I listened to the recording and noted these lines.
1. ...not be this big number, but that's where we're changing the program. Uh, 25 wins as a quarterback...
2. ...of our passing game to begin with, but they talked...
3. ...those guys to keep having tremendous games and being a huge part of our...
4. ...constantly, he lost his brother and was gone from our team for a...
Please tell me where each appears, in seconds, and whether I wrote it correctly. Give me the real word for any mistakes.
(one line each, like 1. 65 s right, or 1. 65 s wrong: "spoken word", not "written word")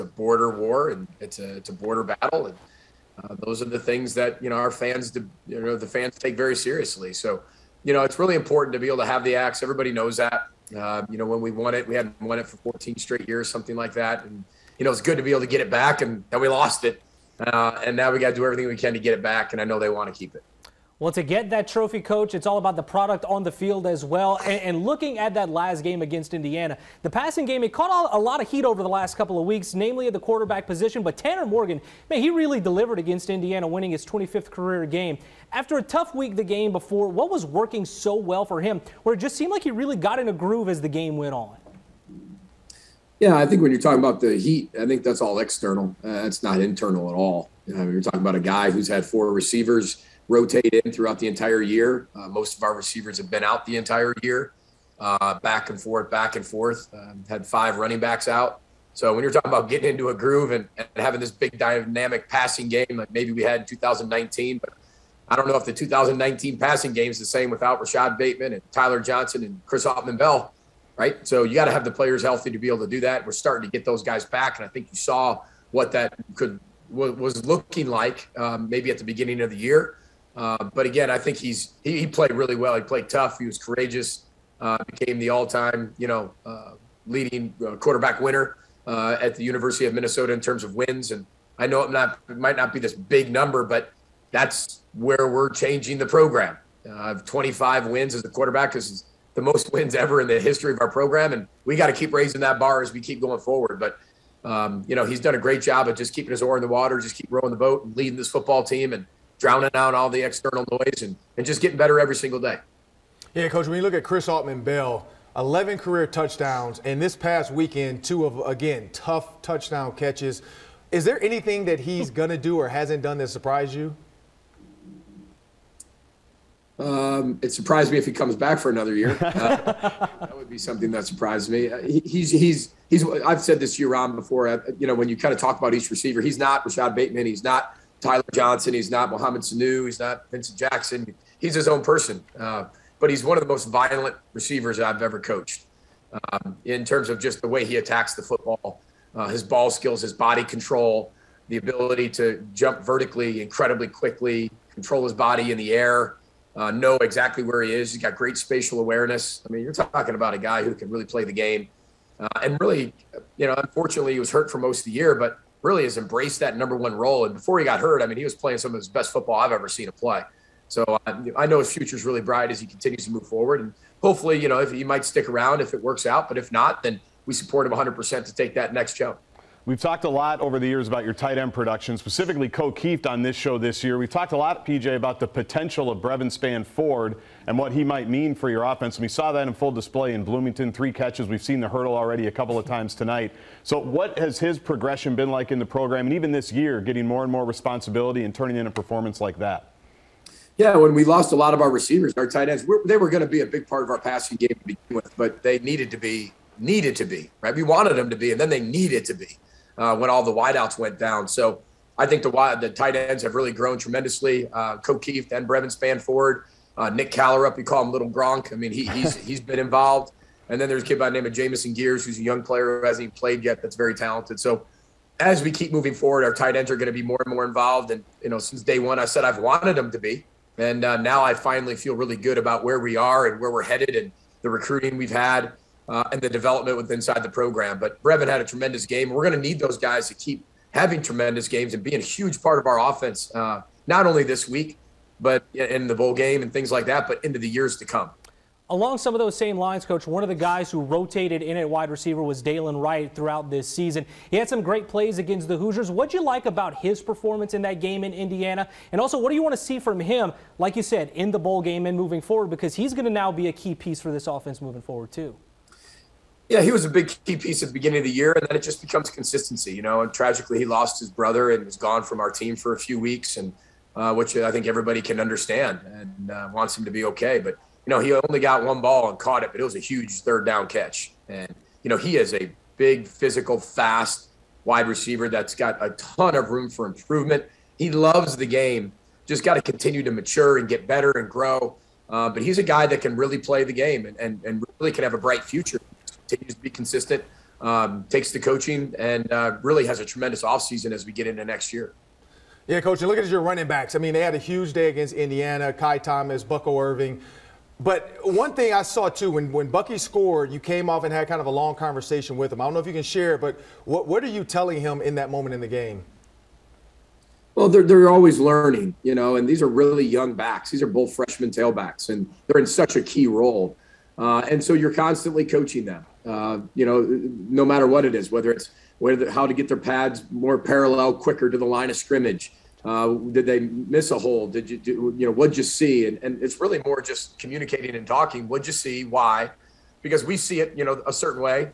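1. 92 s right
2. 203 s wrong: "needed", not "talked"
3. 239 s right
4. 270 s wrong: "tragically", not "constantly".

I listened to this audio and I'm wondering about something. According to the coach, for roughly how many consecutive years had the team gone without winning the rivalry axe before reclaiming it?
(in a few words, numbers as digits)
14.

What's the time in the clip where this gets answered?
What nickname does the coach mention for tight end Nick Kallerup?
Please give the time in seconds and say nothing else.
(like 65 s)
217 s.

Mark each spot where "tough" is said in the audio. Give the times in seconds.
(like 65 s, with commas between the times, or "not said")
35 s, 83 s, 118 s.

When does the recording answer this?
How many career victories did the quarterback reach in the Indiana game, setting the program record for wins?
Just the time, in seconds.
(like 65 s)
34 s.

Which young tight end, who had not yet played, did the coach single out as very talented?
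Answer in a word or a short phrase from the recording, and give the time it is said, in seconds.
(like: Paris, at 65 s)
Jameson Geers, at 221 s.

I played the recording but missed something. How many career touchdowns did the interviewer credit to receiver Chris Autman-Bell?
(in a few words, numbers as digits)
11.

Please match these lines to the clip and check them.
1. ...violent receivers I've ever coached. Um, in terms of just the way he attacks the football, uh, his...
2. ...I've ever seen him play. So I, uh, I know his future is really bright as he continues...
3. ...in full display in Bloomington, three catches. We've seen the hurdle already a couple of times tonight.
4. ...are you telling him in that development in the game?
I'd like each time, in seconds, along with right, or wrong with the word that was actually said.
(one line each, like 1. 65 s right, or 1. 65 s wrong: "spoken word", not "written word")
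1. 143 s right
2. 169 s right
3. 189 s right
4. 314 s wrong: "moment", not "development".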